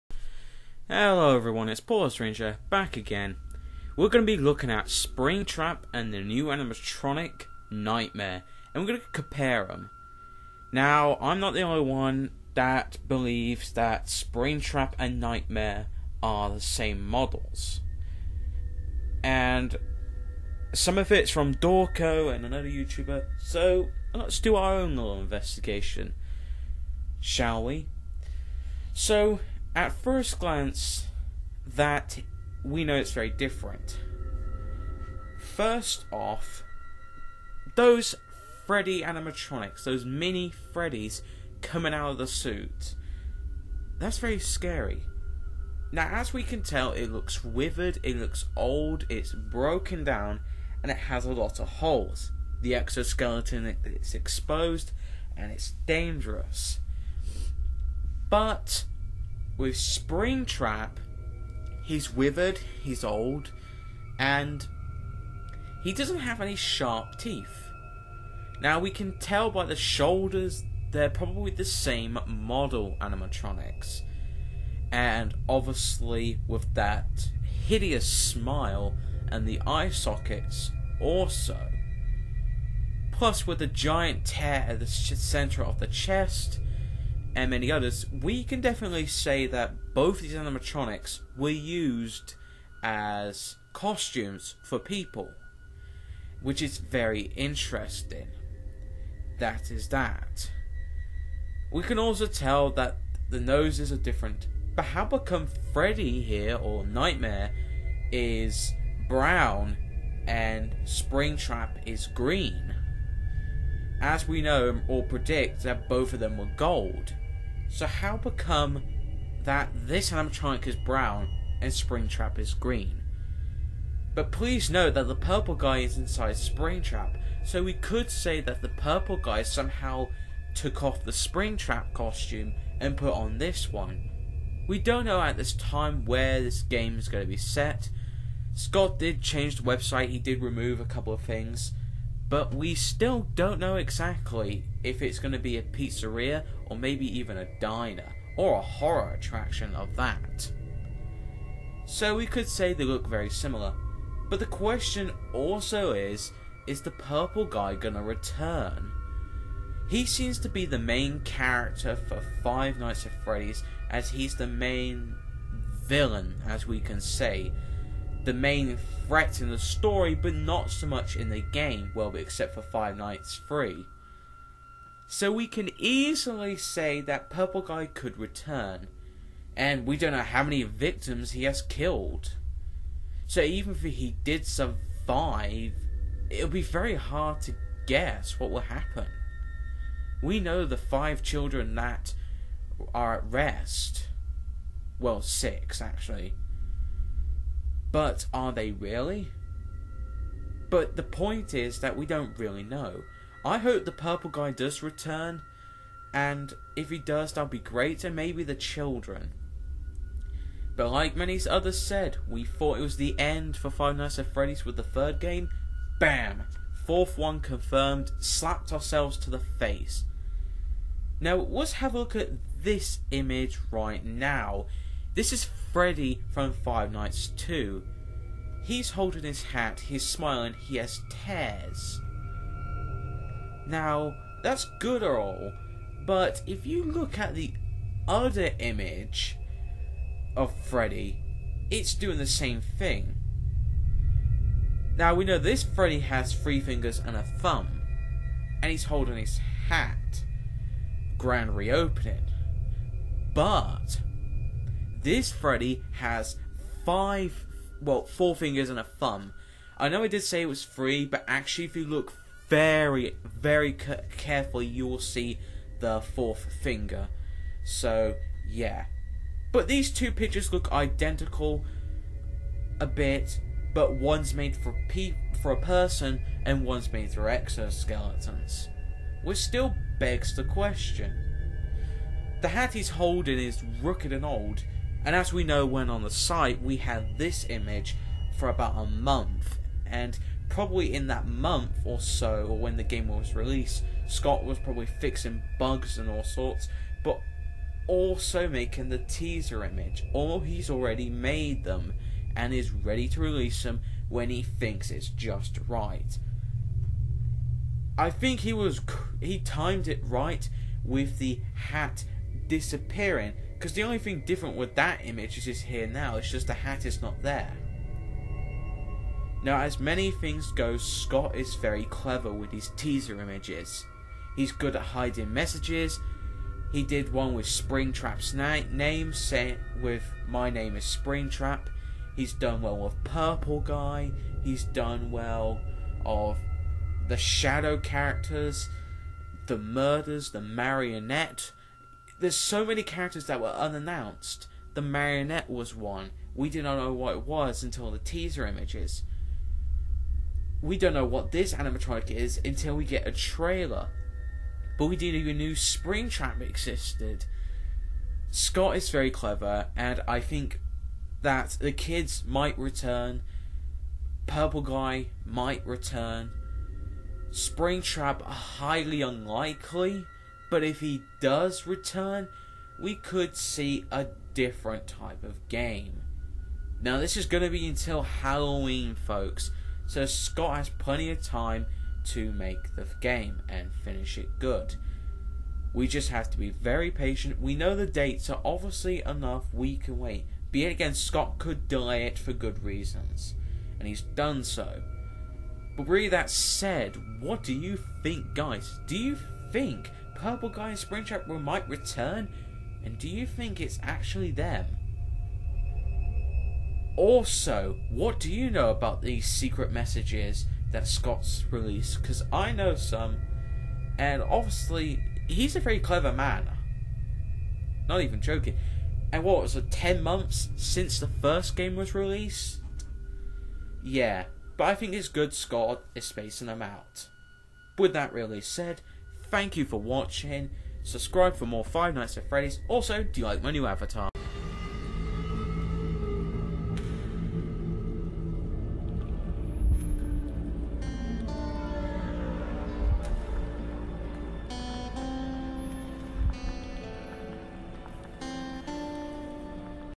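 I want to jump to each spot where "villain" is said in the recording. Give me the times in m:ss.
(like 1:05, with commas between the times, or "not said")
2:45.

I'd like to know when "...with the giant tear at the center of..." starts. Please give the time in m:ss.
1:23.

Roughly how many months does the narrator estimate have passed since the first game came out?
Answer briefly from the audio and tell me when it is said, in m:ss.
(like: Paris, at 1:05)
10, at 6:59.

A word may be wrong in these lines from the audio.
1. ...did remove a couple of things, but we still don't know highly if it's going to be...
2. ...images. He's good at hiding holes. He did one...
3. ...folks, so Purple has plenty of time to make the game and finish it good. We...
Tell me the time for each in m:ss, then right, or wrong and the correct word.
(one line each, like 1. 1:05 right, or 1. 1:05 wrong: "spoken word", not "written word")
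1. 2:20 wrong: "exactly", not "highly"
2. 5:23 wrong: "messages", not "holes"
3. 6:18 wrong: "Scott", not "Purple".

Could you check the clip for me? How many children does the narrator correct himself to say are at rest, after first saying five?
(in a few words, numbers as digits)
6.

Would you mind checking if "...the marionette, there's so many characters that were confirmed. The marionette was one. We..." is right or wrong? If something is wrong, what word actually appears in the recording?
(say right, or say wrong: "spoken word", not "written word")
wrong: "unannounced", not "confirmed".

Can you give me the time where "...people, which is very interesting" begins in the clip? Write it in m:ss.
1:34.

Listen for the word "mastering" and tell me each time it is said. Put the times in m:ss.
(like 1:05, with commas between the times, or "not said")
not said.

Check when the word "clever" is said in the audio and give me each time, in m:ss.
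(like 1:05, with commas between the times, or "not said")
5:21, 5:59, 6:55.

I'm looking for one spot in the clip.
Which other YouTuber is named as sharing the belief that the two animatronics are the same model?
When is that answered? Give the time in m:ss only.
0:21.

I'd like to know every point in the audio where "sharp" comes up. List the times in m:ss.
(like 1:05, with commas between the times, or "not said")
1:06.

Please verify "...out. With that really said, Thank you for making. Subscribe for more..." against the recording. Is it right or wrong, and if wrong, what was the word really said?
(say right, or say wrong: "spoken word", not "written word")
wrong: "watching", not "making".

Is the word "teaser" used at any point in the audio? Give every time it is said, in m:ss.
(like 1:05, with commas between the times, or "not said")
4:58, 5:22, 5:47.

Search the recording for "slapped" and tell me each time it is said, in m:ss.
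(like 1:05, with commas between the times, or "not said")
3:38.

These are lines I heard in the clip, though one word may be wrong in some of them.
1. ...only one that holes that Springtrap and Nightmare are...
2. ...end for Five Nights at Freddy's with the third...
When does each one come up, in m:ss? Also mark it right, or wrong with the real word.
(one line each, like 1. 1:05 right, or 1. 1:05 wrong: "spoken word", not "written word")
1. 0:11 wrong: "believes", not "holes"
2. 3:33 right.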